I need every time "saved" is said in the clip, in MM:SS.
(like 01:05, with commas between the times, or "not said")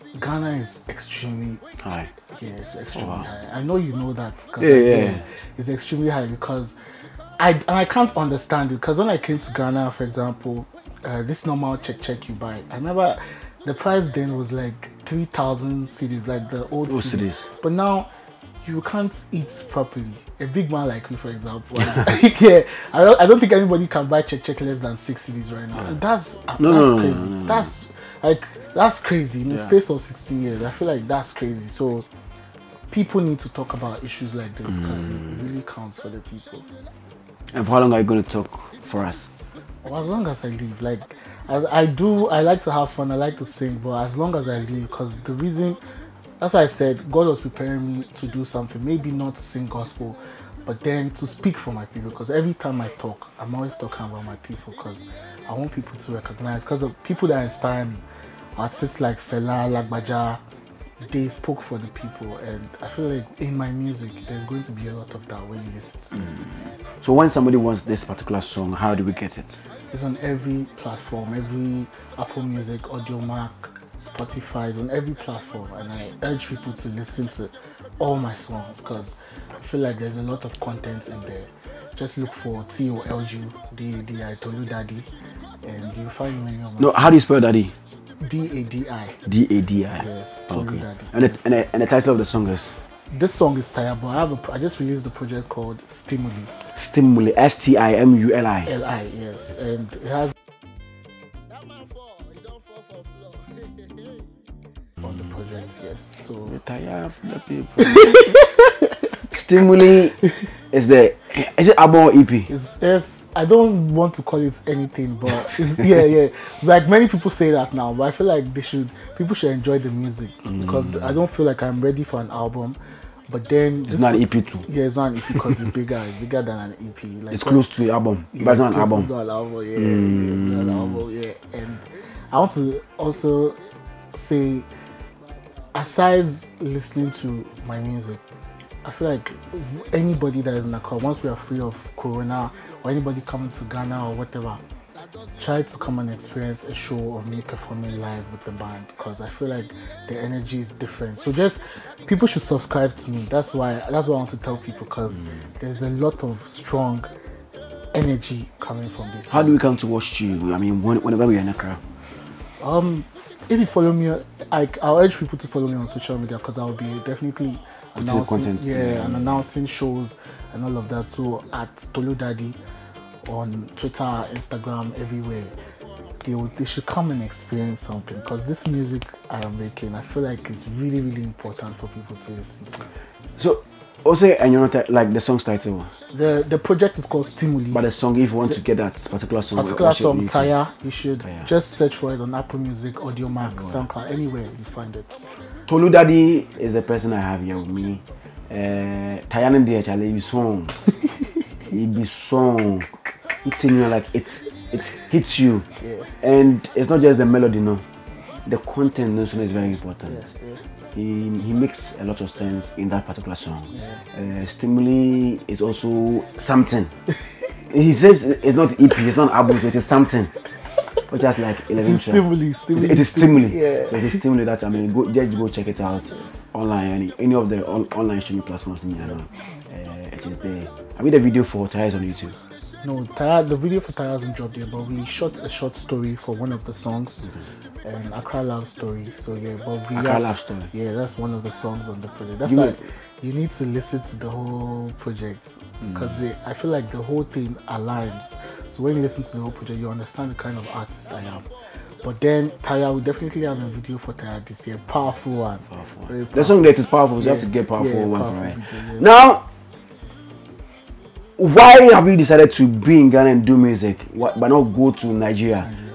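not said.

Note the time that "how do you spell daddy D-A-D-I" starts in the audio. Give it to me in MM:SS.
01:26.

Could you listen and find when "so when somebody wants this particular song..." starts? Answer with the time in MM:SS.
01:07.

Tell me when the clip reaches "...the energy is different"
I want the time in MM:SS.
02:30.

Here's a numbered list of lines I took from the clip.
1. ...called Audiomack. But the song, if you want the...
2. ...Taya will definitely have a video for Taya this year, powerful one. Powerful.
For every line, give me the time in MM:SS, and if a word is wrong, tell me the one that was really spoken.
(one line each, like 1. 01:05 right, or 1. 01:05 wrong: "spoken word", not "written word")
1. 03:07 wrong: "Stimuli", not "Audiomack"
2. 04:12 right.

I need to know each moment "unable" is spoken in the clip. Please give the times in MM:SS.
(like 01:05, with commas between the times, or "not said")
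not said.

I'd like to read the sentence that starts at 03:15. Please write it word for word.
Toludadi is the person I have here with me.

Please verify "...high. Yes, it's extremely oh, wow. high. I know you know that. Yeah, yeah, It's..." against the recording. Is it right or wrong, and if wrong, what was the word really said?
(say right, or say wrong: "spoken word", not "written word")
right.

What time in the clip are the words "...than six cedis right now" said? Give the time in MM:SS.
00:24.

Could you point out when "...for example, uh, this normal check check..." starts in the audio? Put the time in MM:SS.
00:09.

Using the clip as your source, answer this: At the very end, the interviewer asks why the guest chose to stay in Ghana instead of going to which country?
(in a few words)
Nigeria.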